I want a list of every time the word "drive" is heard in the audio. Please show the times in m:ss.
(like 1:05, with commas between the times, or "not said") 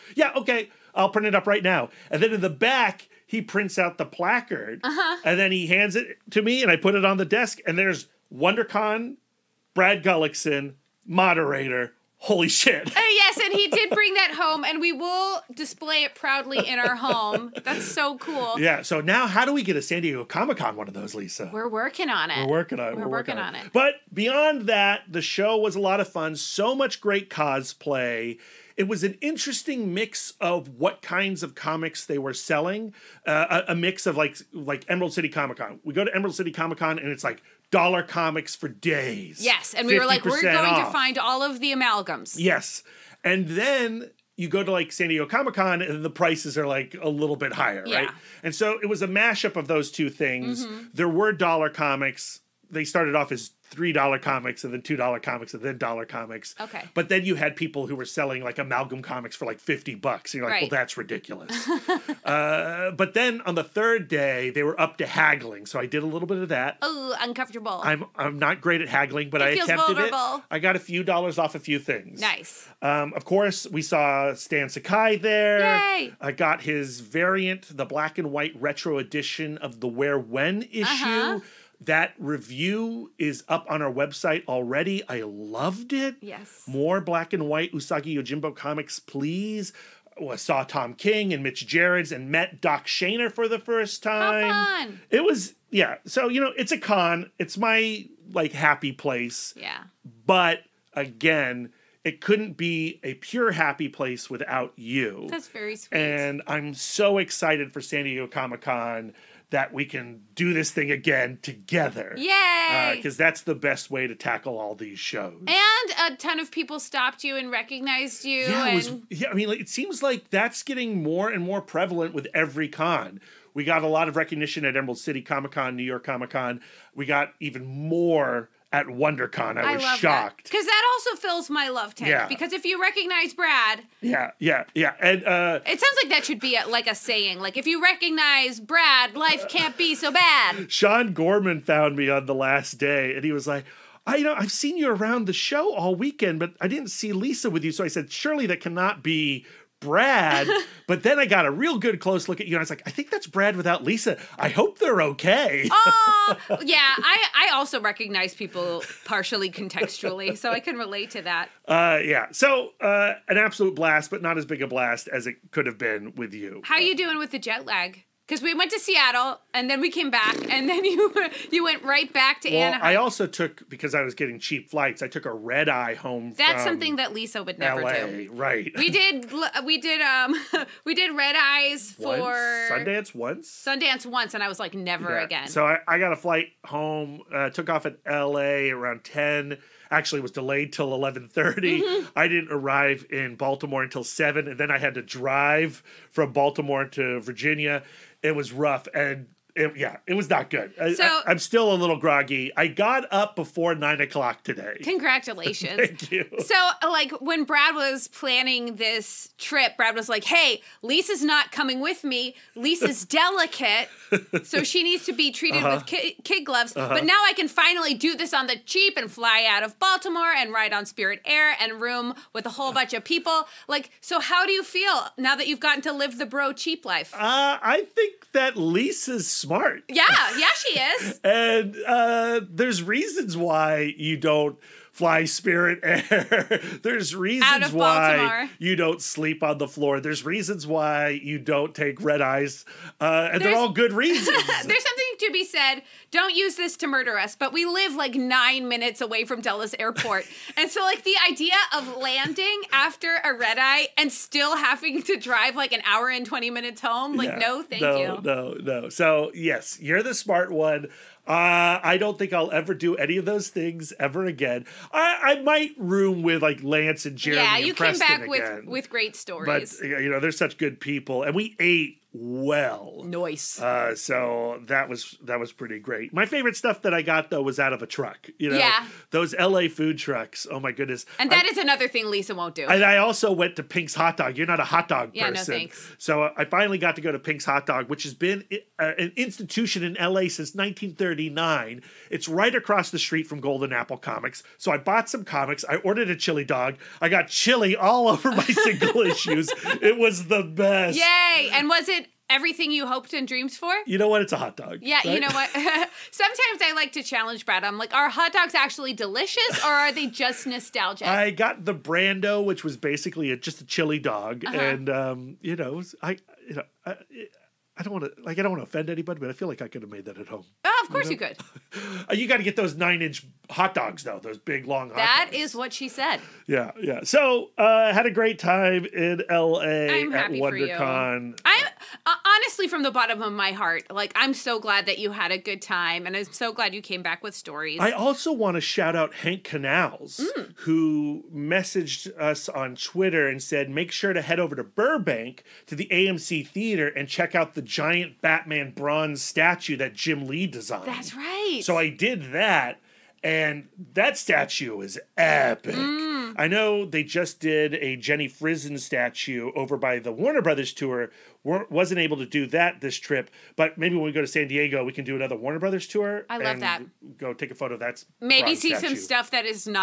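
3:15, 4:15.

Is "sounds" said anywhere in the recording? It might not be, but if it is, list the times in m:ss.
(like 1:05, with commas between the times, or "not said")
2:15.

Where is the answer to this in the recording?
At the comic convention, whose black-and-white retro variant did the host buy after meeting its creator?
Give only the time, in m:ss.
1:14.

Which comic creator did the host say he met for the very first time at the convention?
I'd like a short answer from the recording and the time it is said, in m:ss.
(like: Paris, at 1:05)
Doc Shaner, at 1:32.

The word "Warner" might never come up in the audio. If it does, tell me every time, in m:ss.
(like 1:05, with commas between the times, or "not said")
6:00, 6:05.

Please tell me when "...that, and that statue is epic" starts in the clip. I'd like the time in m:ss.
5:52.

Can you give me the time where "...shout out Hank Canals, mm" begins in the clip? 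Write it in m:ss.
5:38.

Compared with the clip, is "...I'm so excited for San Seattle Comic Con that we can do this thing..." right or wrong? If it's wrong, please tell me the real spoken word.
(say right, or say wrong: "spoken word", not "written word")
wrong: "Diego", not "Seattle".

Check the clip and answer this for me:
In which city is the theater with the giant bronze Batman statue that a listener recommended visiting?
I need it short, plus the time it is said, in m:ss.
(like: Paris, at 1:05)
Burbank, at 5:44.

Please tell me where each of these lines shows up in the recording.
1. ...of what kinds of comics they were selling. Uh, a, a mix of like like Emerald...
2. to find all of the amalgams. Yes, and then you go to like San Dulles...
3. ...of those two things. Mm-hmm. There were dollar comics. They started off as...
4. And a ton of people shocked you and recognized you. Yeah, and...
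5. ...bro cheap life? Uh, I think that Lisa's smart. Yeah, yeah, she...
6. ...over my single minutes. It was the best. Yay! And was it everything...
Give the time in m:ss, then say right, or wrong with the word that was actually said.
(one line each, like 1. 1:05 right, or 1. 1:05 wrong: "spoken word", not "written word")
1. 0:30 right
2. 0:40 wrong: "Diego", not "Dulles"
3. 0:49 right
4. 1:55 wrong: "stopped", not "shocked"
5. 3:46 right
6. 4:58 wrong: "issues", not "minutes".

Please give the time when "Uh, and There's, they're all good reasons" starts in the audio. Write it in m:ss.
4:02.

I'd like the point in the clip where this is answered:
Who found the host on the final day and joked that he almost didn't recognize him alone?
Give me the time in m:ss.
2:20.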